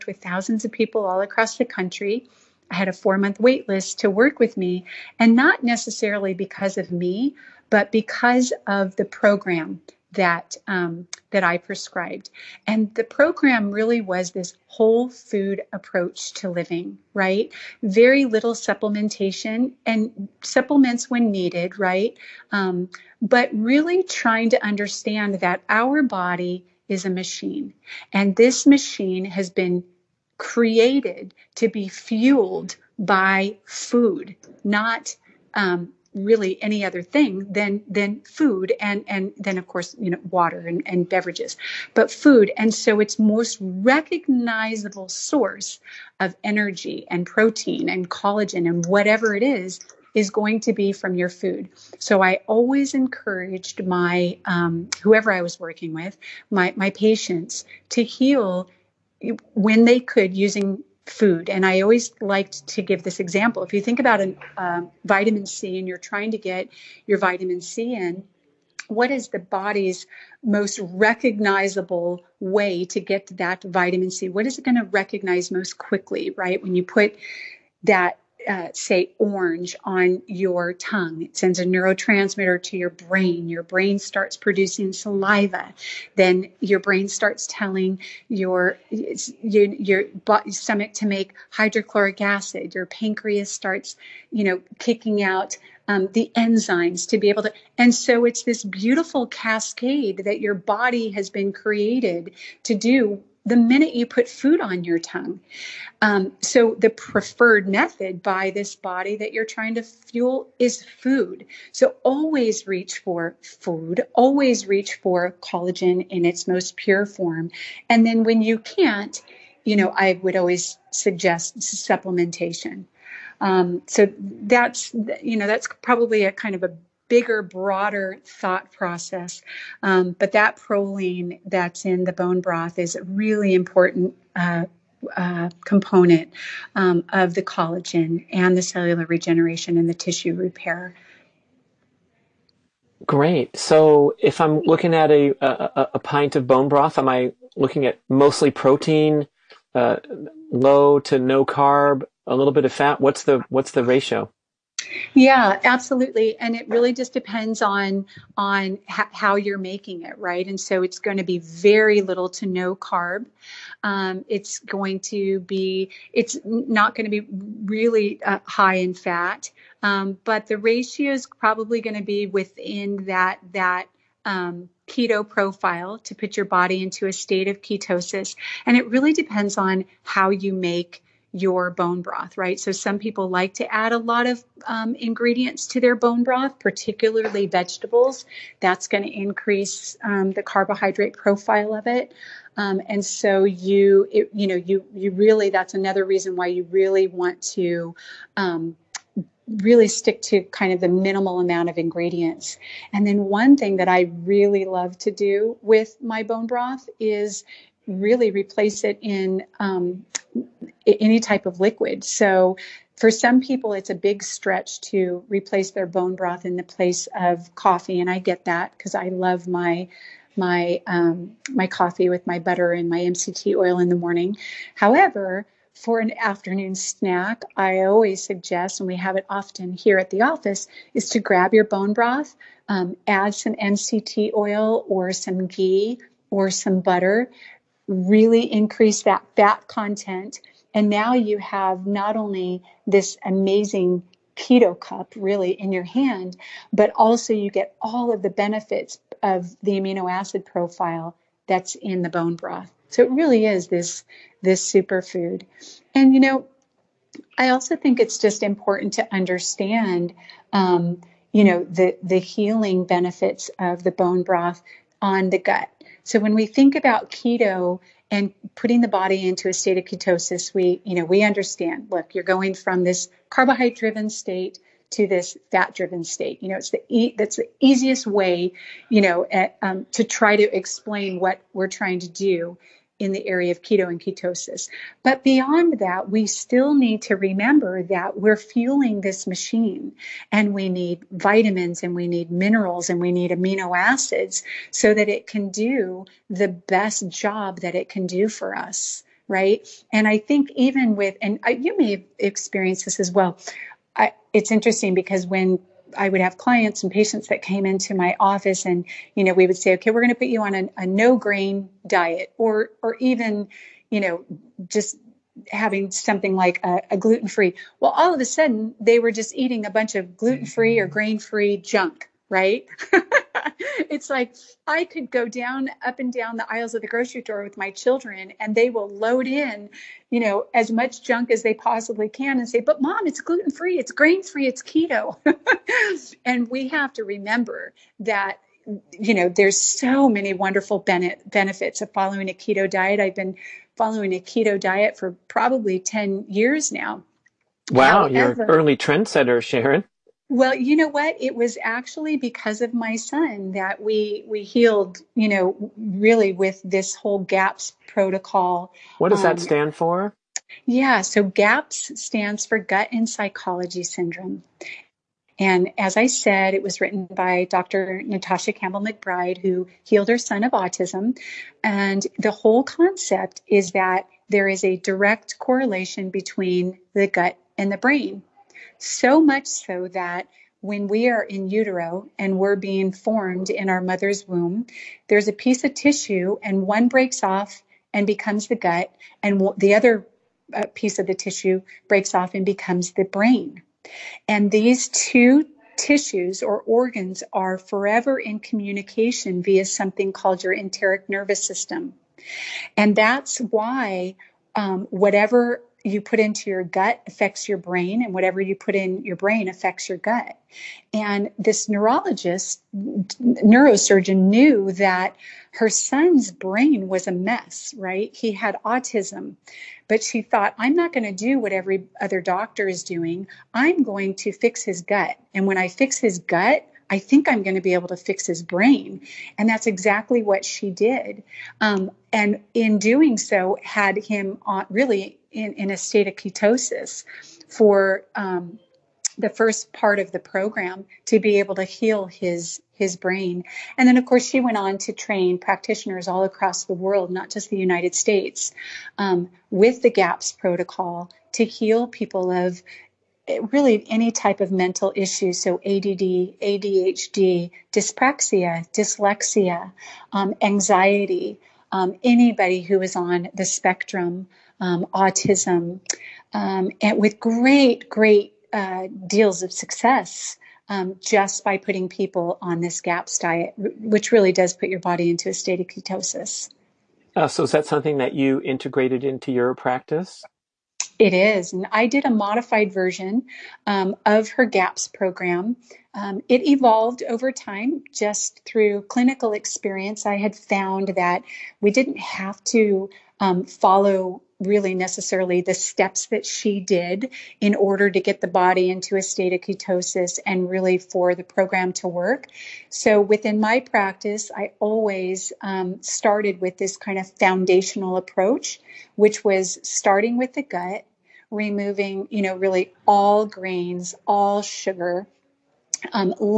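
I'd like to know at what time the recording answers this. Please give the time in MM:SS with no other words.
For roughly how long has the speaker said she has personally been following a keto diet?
05:45.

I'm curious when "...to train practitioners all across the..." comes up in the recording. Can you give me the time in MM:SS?
07:24.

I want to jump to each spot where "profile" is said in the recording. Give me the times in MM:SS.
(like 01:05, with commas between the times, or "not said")
02:55, 03:11, 04:10.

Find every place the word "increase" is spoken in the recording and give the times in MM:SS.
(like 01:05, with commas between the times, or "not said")
03:09, 03:58.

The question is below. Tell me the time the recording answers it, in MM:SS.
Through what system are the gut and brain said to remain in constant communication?
06:40.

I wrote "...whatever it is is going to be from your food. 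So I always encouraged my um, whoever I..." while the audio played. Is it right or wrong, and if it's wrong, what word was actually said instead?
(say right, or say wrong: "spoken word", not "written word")
right.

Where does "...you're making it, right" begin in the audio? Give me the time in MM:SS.
02:39.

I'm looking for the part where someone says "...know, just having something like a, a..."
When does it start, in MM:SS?
05:14.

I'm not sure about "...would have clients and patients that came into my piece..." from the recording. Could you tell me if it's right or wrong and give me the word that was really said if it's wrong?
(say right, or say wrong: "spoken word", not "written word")
wrong: "office", not "piece".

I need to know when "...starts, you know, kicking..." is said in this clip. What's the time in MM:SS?
01:33.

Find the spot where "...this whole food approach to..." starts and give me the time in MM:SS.
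00:14.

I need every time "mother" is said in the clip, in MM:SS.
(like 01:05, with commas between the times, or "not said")
06:23.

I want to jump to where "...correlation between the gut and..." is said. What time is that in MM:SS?
06:15.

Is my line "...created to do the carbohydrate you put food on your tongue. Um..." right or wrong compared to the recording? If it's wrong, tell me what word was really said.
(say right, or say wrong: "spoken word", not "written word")
wrong: "minute", not "carbohydrate".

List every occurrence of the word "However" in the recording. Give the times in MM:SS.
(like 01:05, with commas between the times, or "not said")
03:44, 05:48.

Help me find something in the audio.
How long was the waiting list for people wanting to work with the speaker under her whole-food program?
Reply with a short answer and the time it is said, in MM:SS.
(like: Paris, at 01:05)
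4 months, at 00:02.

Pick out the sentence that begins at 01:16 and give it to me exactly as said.
When you put that uh, say orange on your tongue.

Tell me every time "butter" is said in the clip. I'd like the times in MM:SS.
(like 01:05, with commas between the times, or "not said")
03:42, 03:56.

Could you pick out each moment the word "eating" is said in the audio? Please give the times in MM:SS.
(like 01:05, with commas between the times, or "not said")
05:19.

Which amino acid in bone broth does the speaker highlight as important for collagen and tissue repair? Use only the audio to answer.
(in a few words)
Proline.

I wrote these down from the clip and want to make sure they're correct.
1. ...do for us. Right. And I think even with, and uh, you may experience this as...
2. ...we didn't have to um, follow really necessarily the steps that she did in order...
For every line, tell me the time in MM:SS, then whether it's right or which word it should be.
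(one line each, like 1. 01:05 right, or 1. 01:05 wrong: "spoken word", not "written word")
1. 04:58 right
2. 08:11 right.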